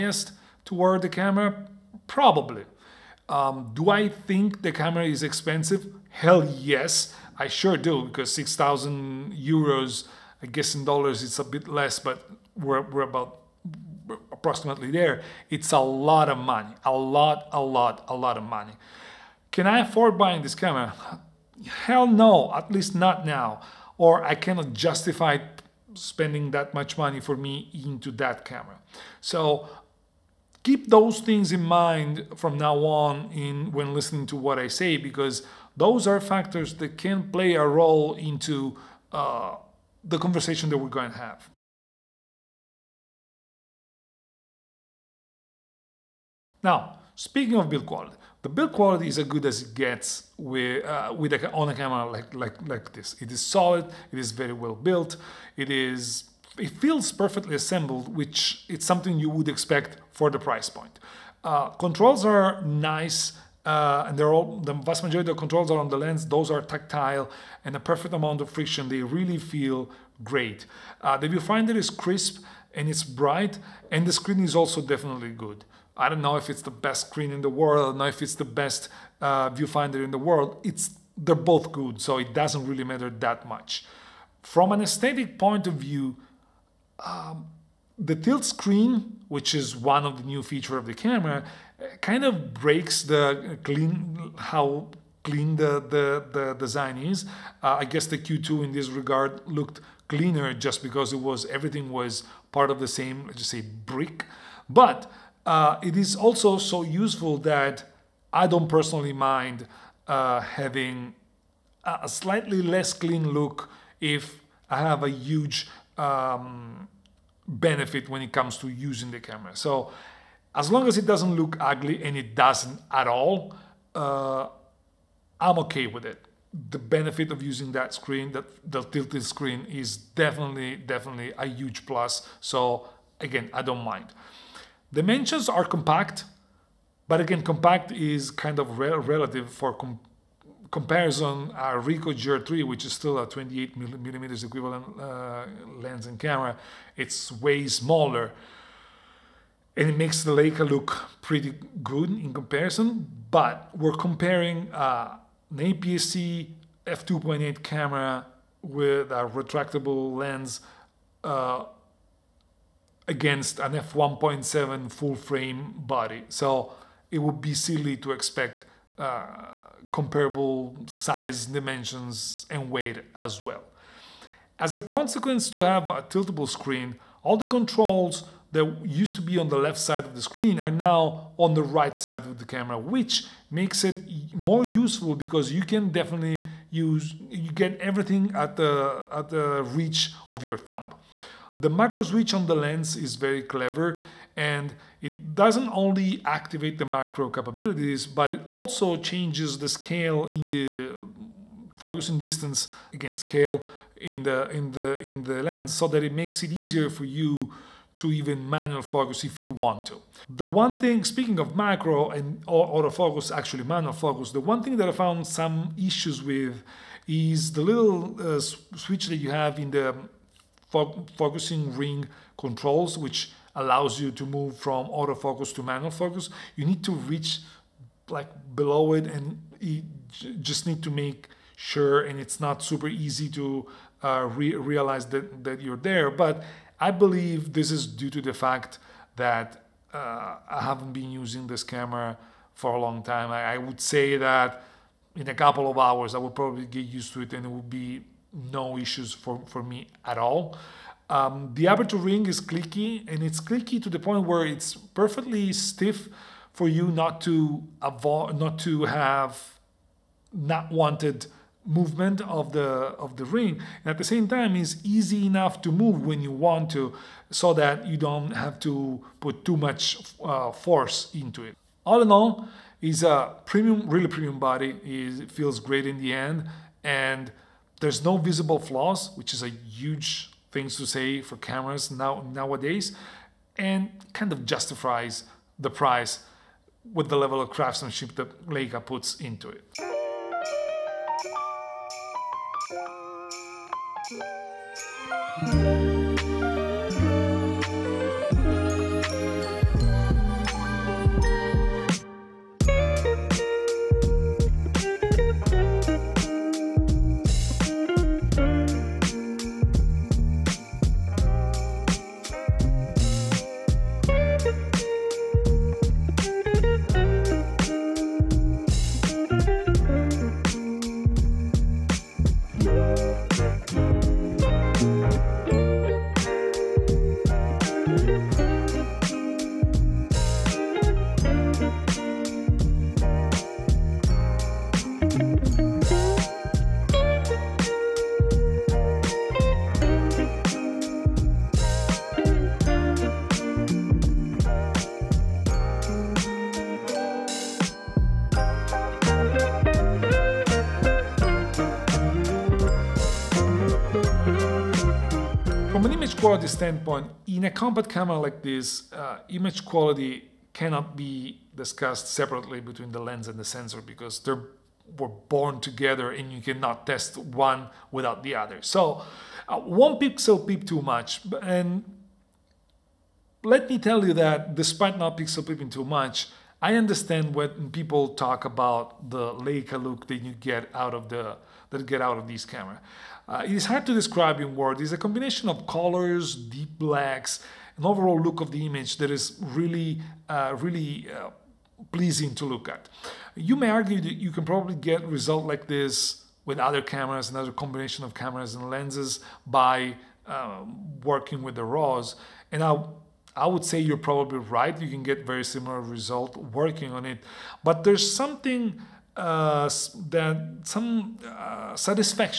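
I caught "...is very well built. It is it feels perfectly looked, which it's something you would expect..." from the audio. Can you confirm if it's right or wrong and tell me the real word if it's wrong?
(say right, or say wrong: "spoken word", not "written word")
wrong: "assembled", not "looked".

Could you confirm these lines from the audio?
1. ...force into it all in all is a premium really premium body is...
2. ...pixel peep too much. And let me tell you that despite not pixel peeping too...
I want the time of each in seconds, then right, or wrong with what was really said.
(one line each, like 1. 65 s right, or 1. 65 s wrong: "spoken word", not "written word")
1. 270 s right
2. 369 s right.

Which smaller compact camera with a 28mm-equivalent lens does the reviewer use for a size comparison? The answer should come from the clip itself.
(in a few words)
Ricoh GR3.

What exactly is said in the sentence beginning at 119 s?
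So as long as it doesn't look ugly and it doesn't at all, uh, I'm okay with it.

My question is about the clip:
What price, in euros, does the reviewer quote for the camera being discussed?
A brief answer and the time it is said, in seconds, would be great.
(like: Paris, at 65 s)
6,000 euros, at 8 s.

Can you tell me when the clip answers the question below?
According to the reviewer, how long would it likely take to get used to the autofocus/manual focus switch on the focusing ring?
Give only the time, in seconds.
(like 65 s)
245 s.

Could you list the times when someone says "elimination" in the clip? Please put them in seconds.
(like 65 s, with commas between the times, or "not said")
not said.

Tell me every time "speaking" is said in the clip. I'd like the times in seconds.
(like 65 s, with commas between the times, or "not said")
47 s, 211 s.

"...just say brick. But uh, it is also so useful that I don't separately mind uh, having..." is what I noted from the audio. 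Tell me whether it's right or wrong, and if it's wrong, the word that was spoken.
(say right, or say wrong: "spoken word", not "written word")
wrong: "personally", not "separately".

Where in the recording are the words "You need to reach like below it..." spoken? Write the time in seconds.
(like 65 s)
226 s.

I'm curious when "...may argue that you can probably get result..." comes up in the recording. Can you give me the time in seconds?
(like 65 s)
393 s.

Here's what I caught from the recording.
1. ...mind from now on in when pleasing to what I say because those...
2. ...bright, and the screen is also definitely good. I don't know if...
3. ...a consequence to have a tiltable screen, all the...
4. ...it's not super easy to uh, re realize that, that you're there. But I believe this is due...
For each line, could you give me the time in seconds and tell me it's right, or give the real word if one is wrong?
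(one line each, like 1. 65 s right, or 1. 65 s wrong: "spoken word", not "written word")
1. 31 s wrong: "listening", not "pleasing"
2. 73 s right
3. 174 s right
4. 232 s right.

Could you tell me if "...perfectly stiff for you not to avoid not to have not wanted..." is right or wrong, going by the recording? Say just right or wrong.
right.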